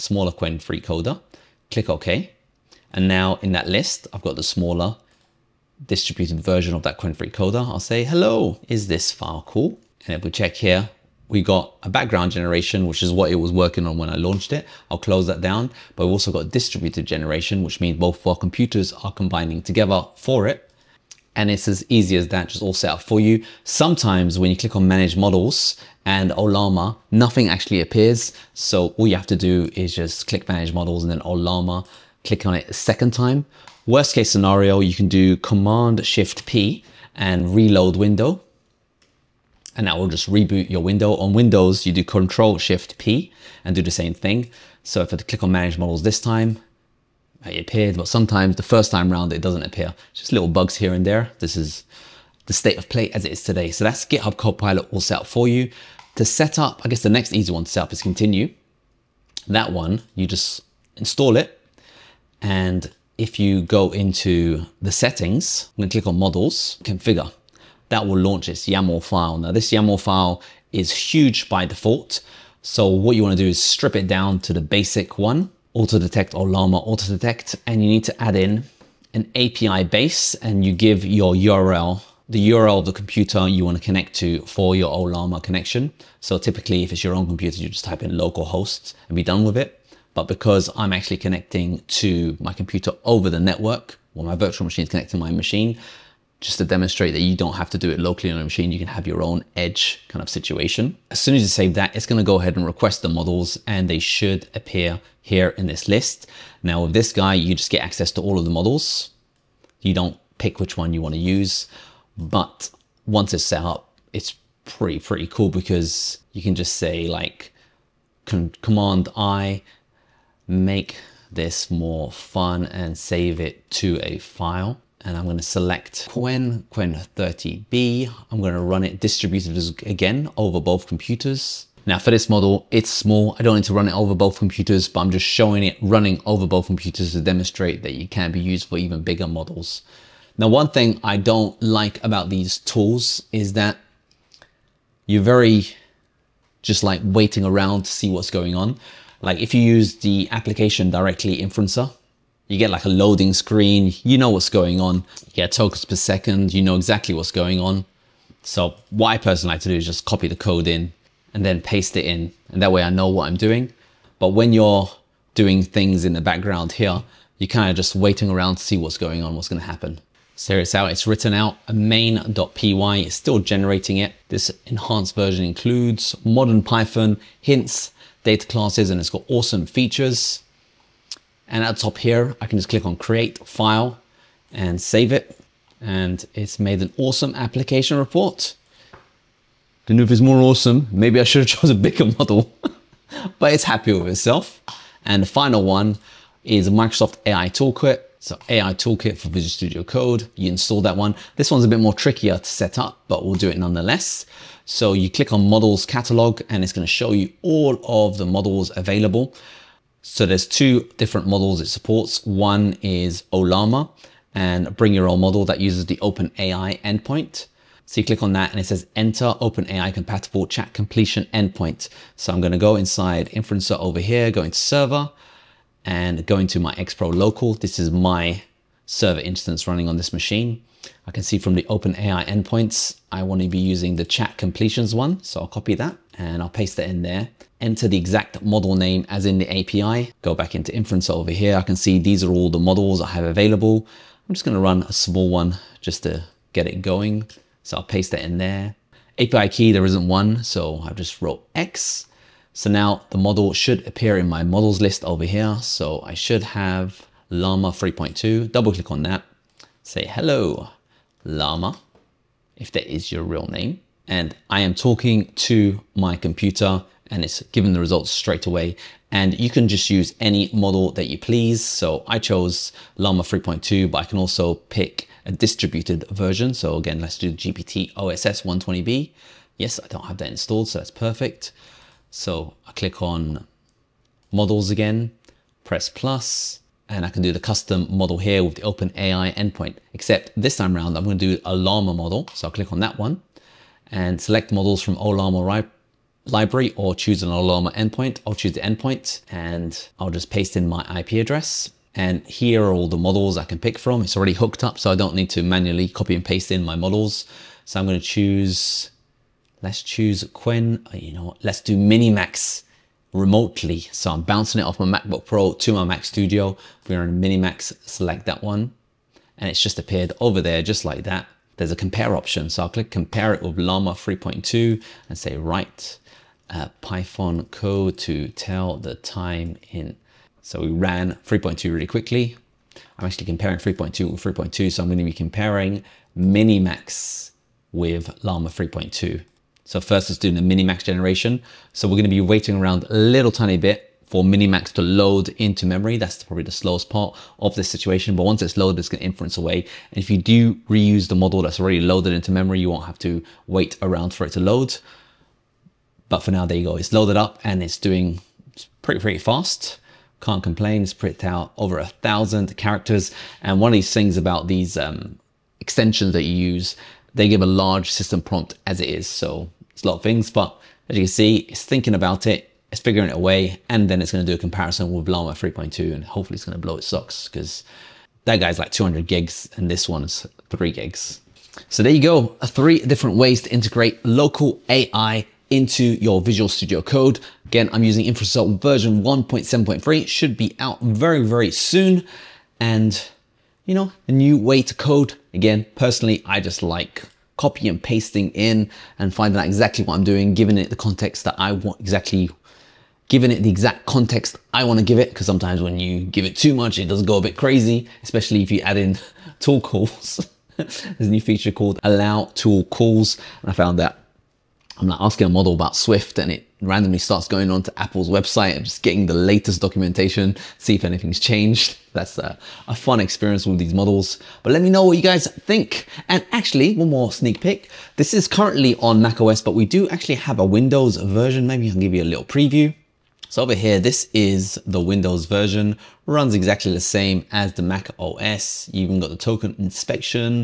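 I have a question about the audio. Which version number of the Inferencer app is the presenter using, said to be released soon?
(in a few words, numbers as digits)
1.7.3.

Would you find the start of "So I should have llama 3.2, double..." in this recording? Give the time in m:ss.
4:15.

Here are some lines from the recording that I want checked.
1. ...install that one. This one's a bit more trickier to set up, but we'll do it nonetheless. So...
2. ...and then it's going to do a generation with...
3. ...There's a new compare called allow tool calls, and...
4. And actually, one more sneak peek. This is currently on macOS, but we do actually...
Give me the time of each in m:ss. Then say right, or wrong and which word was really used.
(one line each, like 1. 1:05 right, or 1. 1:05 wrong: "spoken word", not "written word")
1. 3:20 right
2. 6:13 wrong: "comparison", not "generation"
3. 6:50 wrong: "feature", not "compare"
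4. 7:06 right.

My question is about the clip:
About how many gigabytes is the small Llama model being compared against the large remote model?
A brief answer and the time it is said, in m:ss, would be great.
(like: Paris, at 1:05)
3, at 6:20.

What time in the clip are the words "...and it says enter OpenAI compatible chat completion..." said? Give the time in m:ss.
3:38.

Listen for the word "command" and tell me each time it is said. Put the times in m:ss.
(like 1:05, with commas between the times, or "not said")
0:35, 1:58.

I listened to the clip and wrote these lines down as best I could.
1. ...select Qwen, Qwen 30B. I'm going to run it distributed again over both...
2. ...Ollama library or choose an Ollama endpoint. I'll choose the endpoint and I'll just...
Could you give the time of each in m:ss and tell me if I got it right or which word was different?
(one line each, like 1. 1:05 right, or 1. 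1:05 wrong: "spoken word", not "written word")
1. 2:05 right
2. 4:54 right.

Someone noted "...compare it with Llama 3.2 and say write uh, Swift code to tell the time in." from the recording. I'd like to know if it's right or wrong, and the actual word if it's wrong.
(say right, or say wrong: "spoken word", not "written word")
wrong: "Python", not "Swift".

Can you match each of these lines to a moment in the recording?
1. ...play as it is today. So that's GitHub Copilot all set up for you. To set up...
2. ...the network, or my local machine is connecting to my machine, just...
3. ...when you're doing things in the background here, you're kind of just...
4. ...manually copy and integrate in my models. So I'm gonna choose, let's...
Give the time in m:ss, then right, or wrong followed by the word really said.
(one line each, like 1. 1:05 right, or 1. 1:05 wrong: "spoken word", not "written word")
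1. 0:52 right
2. 1:33 wrong: "virtual", not "local"
3. 2:44 right
4. 5:05 wrong: "paste", not "integrate".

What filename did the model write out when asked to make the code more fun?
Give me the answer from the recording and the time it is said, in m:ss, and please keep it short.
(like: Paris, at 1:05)
main.py, at 2:51.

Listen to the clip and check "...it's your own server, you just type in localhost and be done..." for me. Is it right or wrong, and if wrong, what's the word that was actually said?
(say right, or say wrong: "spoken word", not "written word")
wrong: "computer", not "server".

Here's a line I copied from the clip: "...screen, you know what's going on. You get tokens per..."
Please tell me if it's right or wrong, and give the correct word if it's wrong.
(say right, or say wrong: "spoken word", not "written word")
right.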